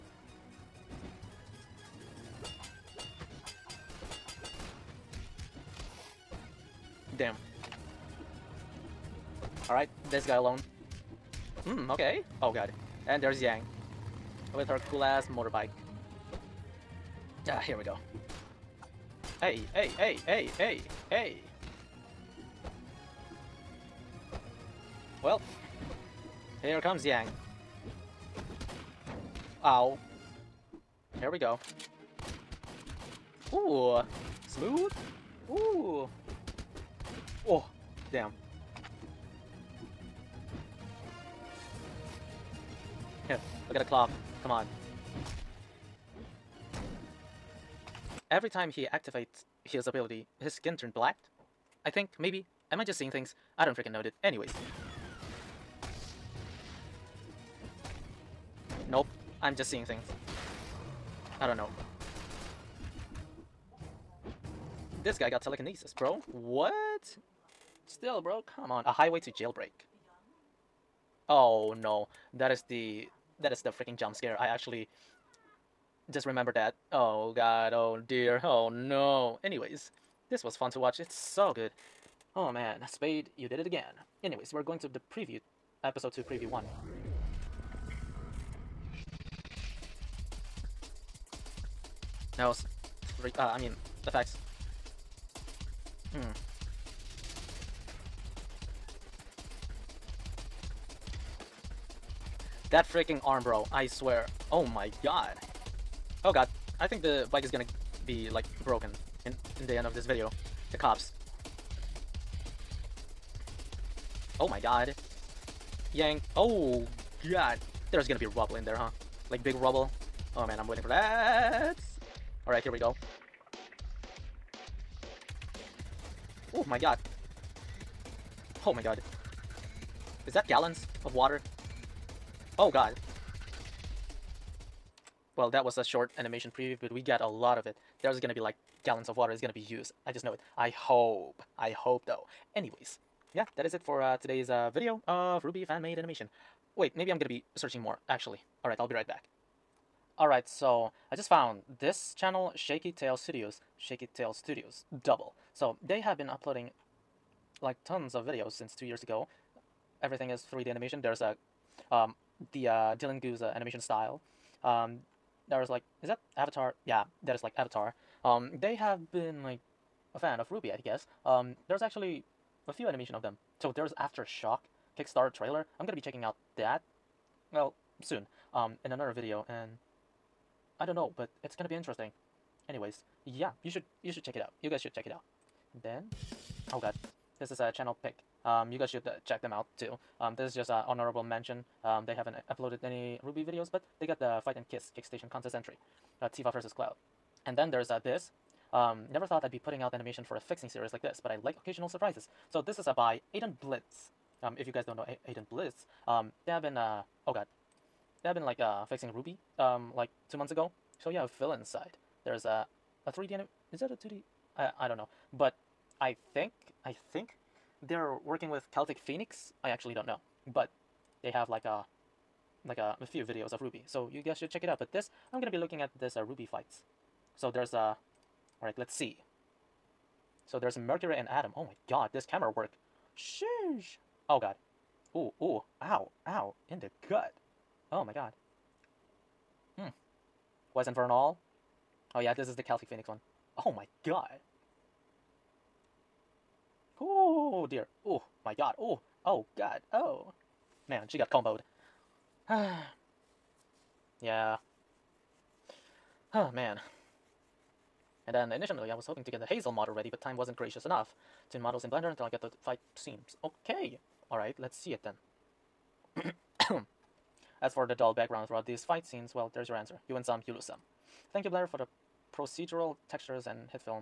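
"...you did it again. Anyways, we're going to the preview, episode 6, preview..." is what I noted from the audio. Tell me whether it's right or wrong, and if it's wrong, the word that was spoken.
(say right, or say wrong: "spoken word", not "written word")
wrong: "2", not "6".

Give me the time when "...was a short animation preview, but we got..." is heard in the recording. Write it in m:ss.
2:15.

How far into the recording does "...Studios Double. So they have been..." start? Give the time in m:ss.
2:34.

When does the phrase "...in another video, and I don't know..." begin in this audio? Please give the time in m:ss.
2:58.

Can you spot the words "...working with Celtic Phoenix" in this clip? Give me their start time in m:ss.
3:38.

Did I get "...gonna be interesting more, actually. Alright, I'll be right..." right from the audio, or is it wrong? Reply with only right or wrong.
wrong.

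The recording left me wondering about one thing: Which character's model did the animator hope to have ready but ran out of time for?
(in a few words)
Hazel.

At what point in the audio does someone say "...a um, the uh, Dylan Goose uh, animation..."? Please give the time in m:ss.
2:41.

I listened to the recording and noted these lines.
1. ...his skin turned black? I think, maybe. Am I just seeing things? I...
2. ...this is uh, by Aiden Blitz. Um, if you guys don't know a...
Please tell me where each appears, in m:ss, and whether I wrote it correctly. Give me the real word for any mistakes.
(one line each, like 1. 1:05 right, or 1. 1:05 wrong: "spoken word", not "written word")
1. 0:50 right
2. 3:22 right.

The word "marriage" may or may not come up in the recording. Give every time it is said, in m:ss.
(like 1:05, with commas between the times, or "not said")
not said.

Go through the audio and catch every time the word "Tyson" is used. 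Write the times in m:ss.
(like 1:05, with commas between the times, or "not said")
not said.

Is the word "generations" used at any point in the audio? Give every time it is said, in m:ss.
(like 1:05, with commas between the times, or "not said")
not said.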